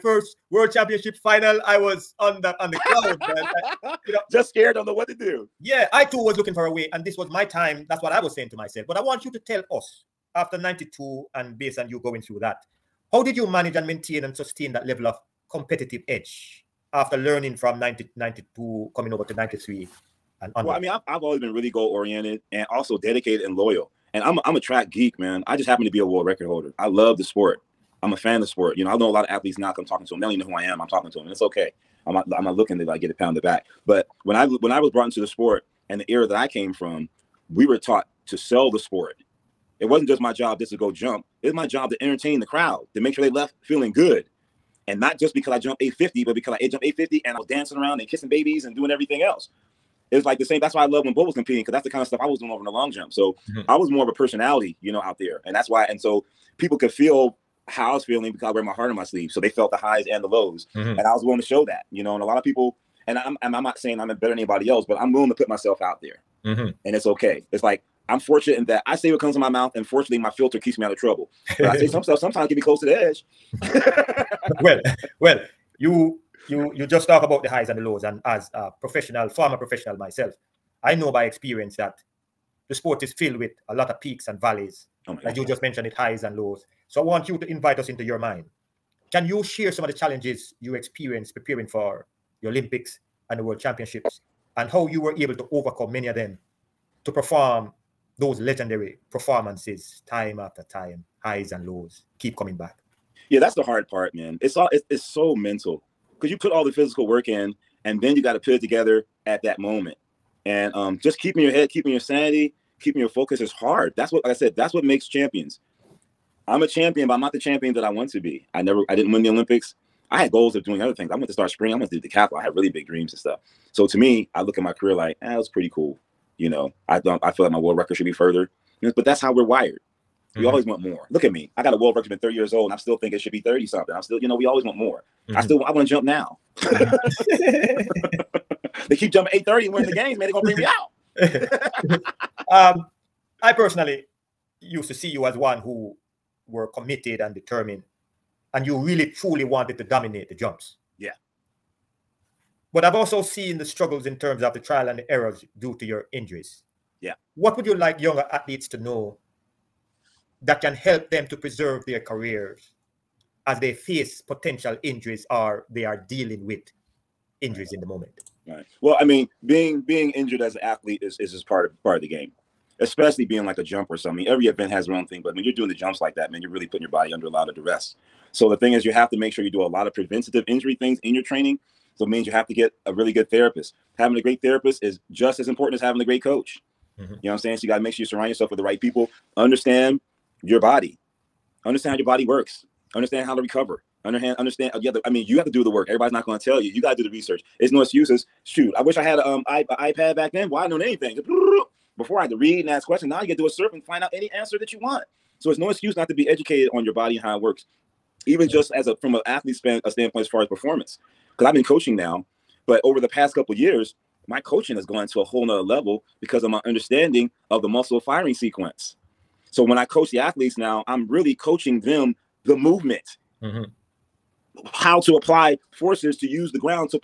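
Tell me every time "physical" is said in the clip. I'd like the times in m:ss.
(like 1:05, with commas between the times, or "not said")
1:46.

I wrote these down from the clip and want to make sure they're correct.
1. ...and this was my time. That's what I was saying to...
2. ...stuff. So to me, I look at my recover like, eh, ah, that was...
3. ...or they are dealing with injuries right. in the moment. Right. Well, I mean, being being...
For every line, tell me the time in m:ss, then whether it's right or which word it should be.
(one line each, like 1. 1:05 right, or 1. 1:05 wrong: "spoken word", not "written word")
1. 0:06 right
2. 2:03 wrong: "career", not "recover"
3. 2:45 right.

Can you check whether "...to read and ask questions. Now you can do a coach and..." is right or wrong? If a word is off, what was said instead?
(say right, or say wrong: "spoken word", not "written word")
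wrong: "search", not "coach".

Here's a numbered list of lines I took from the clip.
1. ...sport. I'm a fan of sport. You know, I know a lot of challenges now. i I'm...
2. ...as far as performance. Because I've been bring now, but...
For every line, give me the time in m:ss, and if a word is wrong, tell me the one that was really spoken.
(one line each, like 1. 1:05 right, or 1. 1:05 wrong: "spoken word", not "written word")
1. 0:27 wrong: "athletes", not "challenges"
2. 3:30 wrong: "coaching", not "bring".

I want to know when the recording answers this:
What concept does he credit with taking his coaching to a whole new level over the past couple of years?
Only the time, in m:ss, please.
3:37.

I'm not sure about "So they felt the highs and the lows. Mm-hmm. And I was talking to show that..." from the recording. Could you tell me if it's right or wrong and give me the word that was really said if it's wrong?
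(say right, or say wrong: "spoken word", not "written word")
wrong: "willing", not "talking".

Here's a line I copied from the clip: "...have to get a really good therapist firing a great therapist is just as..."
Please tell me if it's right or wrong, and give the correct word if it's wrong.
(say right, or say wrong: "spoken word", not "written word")
wrong: "having", not "firing".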